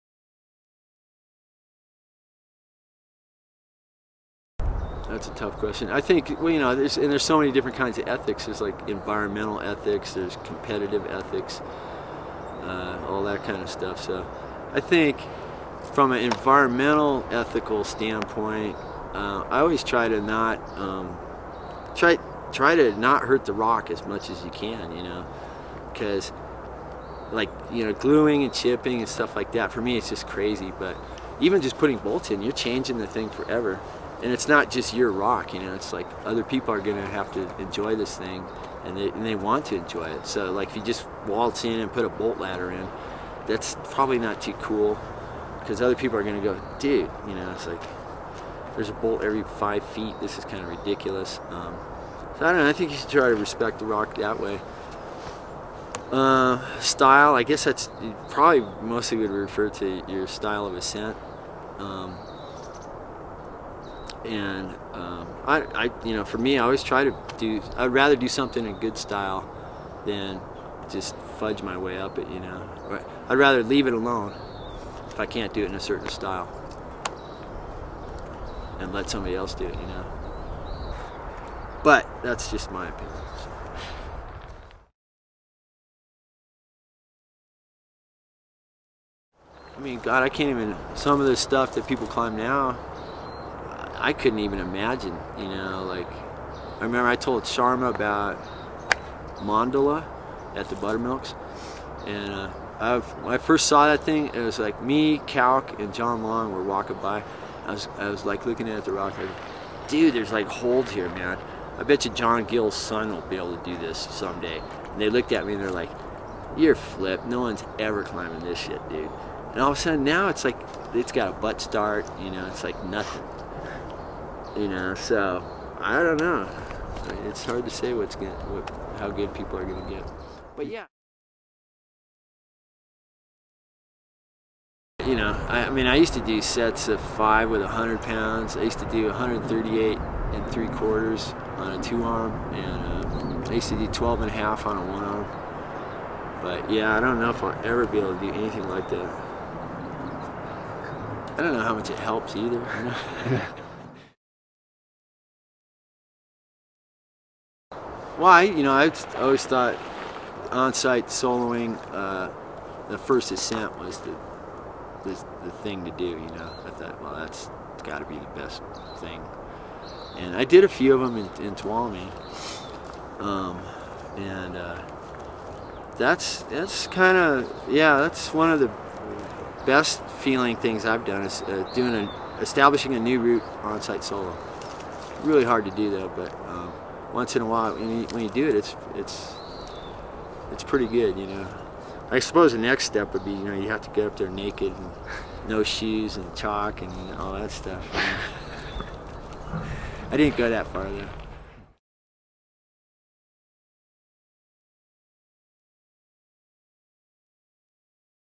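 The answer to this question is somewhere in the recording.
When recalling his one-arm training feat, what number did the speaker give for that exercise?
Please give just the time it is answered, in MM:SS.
02:23.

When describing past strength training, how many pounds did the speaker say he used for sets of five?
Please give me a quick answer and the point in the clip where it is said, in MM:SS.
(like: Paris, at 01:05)
100, at 02:17.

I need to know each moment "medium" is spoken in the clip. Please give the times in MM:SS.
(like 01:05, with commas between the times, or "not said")
not said.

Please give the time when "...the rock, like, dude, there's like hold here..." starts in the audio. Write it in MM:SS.
01:48.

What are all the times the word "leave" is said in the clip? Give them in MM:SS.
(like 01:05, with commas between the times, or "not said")
01:13.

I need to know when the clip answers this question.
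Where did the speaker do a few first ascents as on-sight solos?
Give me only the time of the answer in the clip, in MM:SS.
02:51.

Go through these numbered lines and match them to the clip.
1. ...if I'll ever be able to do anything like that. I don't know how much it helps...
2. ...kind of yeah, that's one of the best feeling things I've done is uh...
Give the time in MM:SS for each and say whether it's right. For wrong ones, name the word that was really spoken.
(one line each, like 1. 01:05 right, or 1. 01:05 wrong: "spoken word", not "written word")
1. 02:27 right
2. 02:56 right.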